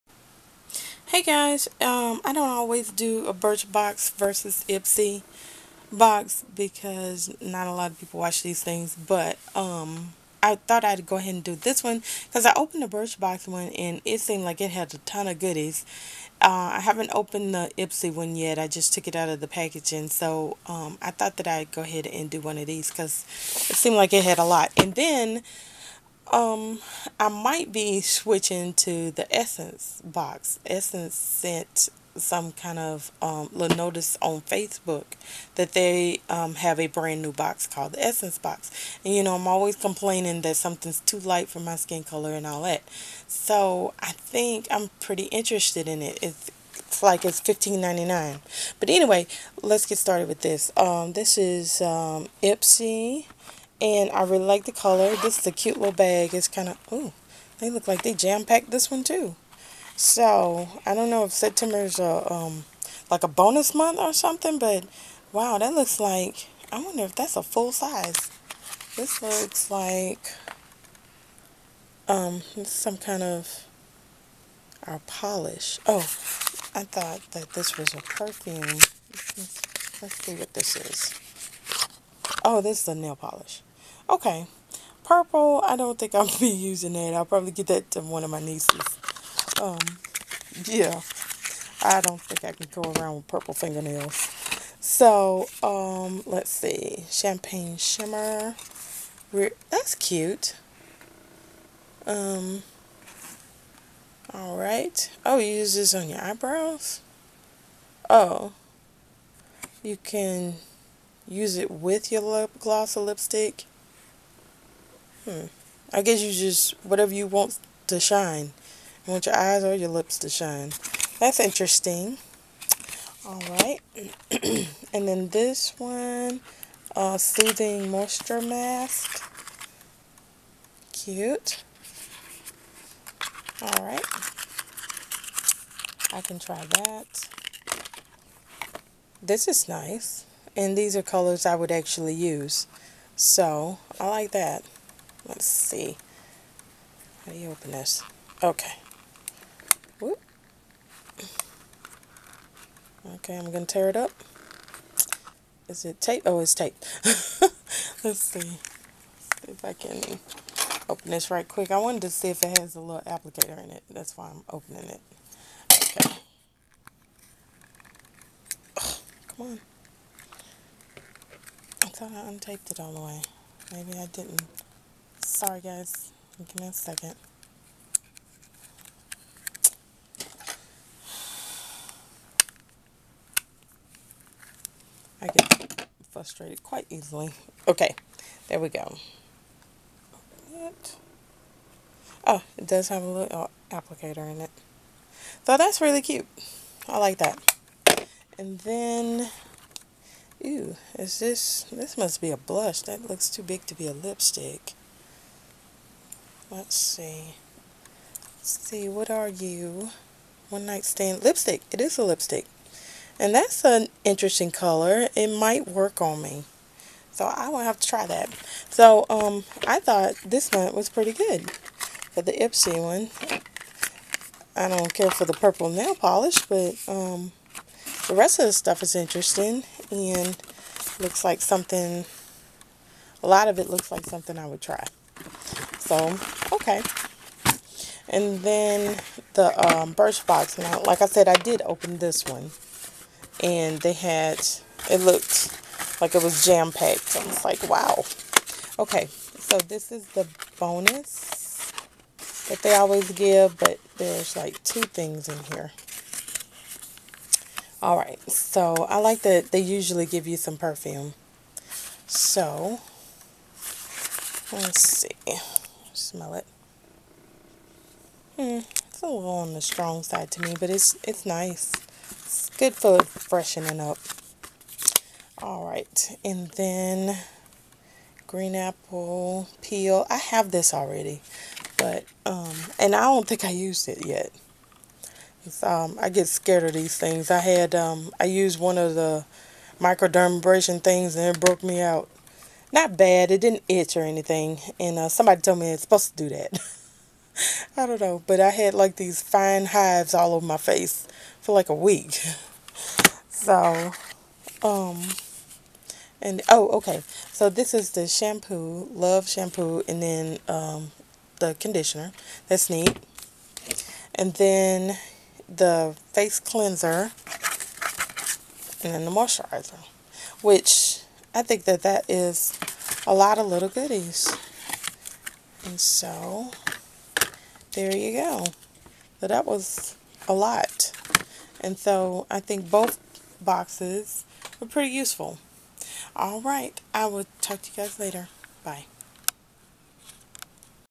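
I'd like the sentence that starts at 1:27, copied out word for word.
I'll probably get that to one of my nieces.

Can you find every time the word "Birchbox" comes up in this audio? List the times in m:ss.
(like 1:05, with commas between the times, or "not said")
0:03, 0:12, 3:59.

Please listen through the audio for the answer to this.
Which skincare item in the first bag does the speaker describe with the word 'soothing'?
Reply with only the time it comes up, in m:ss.
2:07.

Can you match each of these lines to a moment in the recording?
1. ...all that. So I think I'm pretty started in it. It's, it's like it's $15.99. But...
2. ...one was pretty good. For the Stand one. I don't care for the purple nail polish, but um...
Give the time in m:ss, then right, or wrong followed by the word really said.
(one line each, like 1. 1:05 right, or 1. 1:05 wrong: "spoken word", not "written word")
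1. 0:42 wrong: "interested", not "started"
2. 3:40 wrong: "Ipsy", not "Stand".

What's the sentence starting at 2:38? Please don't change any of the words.
Let's see if I can open this right quick.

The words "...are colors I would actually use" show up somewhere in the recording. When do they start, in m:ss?
2:20.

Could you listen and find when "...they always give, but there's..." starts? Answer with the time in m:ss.
4:12.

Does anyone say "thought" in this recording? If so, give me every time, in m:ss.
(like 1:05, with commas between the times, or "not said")
0:10, 0:21, 1:16, 2:51, 3:39.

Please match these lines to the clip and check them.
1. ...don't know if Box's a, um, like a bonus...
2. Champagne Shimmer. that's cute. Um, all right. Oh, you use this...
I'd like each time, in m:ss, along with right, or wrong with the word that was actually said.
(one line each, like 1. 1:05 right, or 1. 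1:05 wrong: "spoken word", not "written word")
1. 1:00 wrong: "September", not "Box"
2. 1:37 right.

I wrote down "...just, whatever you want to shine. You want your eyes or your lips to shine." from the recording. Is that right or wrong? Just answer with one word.
right.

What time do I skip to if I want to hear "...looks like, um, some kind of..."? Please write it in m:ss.
1:09.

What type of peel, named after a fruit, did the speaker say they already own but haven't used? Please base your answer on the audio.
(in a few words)
green apple peel.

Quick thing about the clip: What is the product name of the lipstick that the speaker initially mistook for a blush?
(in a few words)
One Night Stand.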